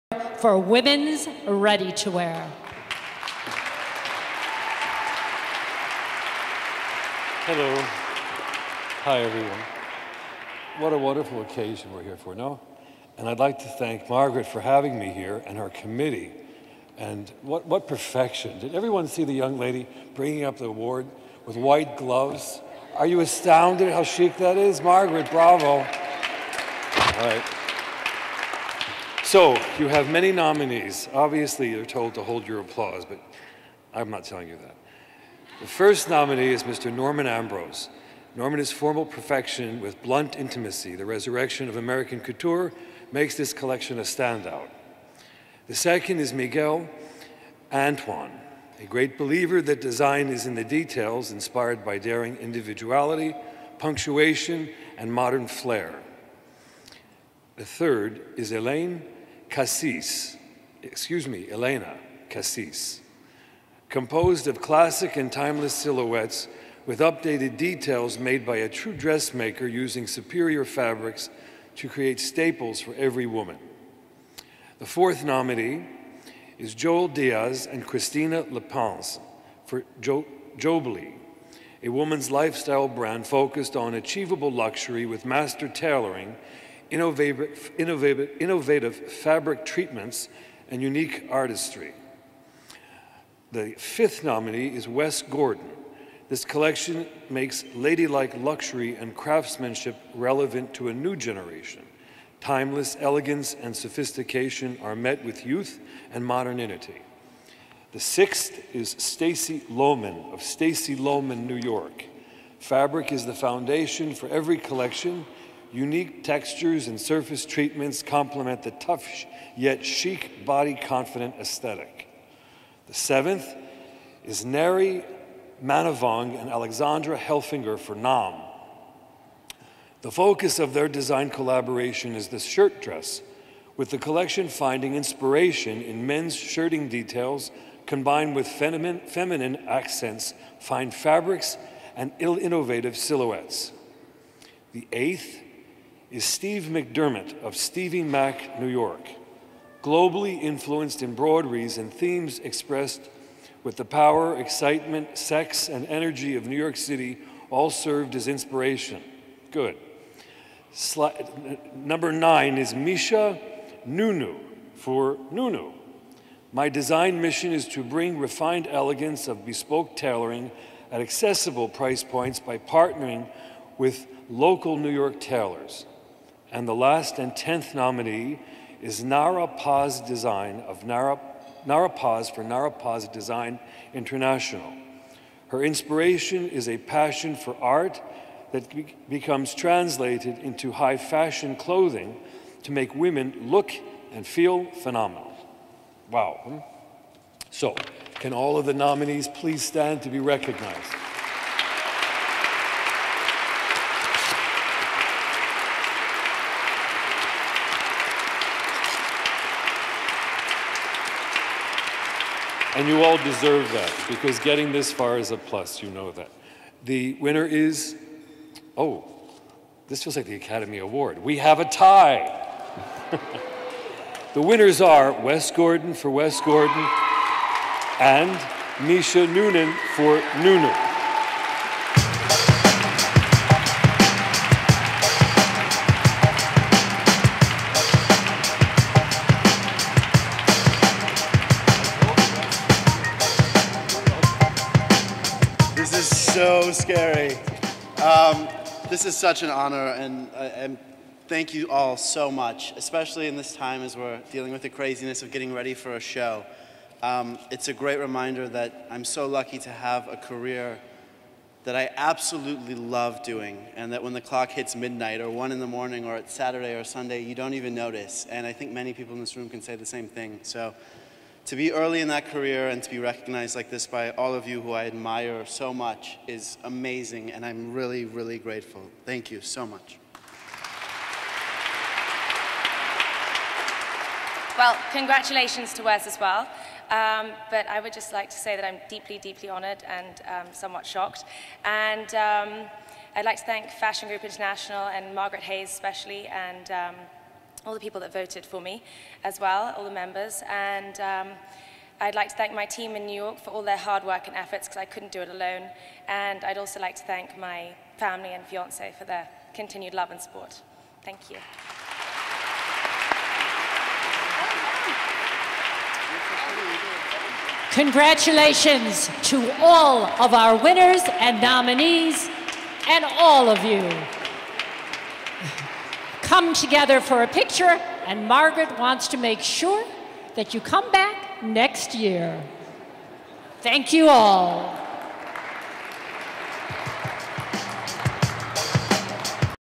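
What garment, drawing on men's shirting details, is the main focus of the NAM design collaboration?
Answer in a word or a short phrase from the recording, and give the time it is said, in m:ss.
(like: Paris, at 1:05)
shirt dress, at 2:12.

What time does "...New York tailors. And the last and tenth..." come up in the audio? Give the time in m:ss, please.
2:54.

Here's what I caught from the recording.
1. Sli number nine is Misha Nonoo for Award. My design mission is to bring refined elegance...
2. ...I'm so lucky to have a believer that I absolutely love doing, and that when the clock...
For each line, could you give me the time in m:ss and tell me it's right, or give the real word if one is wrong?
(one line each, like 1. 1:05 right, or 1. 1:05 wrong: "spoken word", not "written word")
1. 2:40 wrong: "Nonoo", not "Award"
2. 4:18 wrong: "career", not "believer".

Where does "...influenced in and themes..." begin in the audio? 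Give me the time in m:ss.
2:30.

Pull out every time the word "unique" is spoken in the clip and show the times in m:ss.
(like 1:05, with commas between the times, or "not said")
1:30, 1:55.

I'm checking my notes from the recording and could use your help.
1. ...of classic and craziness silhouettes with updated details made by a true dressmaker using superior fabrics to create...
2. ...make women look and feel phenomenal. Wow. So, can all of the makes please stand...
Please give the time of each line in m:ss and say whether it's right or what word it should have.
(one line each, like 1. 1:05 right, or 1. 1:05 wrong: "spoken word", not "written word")
1. 1:04 wrong: "timeless", not "craziness"
2. 3:12 wrong: "nominees", not "makes".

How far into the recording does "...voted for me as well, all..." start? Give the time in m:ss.
4:58.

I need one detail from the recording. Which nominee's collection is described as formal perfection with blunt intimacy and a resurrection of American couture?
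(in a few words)
Norman Ambrose.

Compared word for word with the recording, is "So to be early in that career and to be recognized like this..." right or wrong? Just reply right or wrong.
right.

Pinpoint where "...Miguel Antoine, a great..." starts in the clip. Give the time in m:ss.
0:46.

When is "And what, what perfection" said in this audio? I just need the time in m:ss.
0:16.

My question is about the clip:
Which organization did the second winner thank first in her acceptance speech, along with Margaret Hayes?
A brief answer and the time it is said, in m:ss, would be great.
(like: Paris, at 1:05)
Fashion Group International, at 4:53.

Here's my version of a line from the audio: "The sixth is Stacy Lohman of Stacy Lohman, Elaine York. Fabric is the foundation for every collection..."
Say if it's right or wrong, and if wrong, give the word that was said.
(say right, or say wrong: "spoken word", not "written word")
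wrong: "New", not "Elaine".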